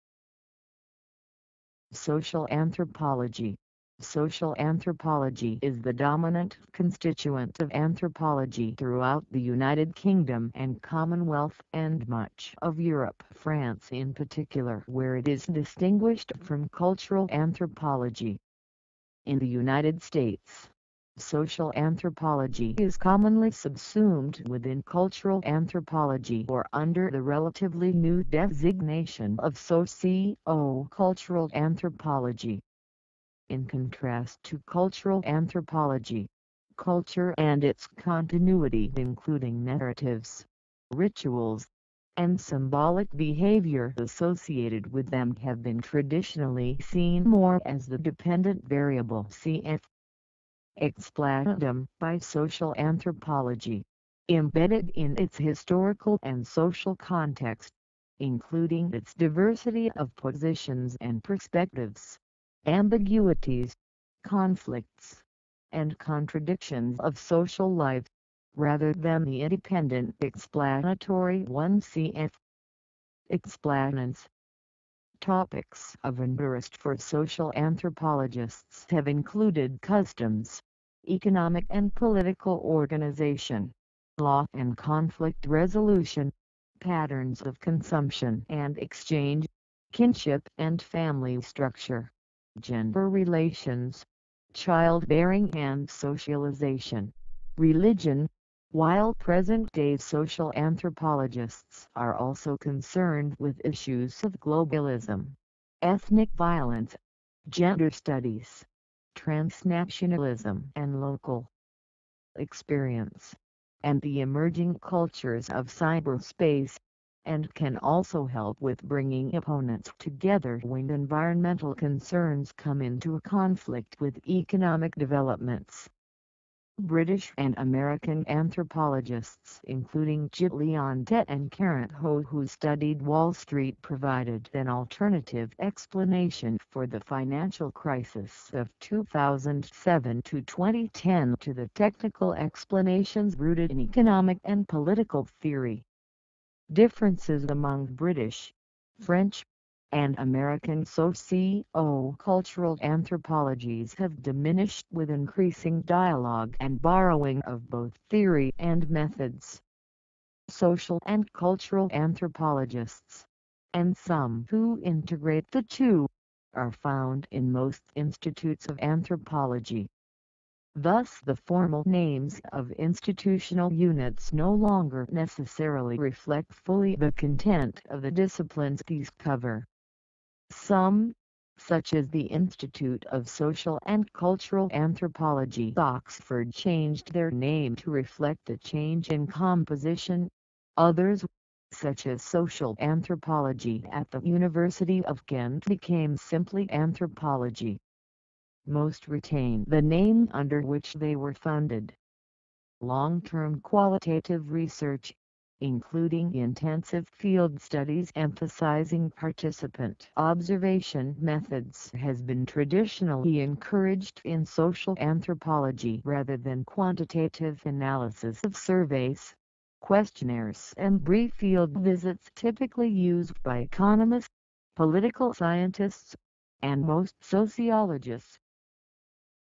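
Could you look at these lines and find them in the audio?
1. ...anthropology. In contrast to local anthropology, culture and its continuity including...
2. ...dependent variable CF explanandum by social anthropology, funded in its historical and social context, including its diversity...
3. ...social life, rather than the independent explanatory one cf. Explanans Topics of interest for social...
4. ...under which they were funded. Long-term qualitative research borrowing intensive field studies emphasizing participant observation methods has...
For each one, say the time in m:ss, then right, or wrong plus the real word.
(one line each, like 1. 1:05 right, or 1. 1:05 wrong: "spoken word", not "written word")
1. 0:31 wrong: "cultural", not "local"
2. 0:47 wrong: "embedded", not "funded"
3. 1:07 right
4. 3:20 wrong: "including", not "borrowing".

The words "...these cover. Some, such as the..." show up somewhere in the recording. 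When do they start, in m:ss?
2:58.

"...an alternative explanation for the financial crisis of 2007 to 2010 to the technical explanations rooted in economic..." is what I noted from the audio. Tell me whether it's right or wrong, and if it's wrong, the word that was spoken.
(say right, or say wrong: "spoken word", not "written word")
right.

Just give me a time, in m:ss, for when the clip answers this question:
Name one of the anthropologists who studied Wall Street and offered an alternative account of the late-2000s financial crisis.
2:10.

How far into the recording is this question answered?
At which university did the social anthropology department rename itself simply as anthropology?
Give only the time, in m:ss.
3:14.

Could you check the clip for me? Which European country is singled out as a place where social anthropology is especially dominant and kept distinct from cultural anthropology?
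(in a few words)
France.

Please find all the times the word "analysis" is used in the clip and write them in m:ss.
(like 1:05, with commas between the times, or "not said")
3:37.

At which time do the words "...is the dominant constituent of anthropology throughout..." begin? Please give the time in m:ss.
0:05.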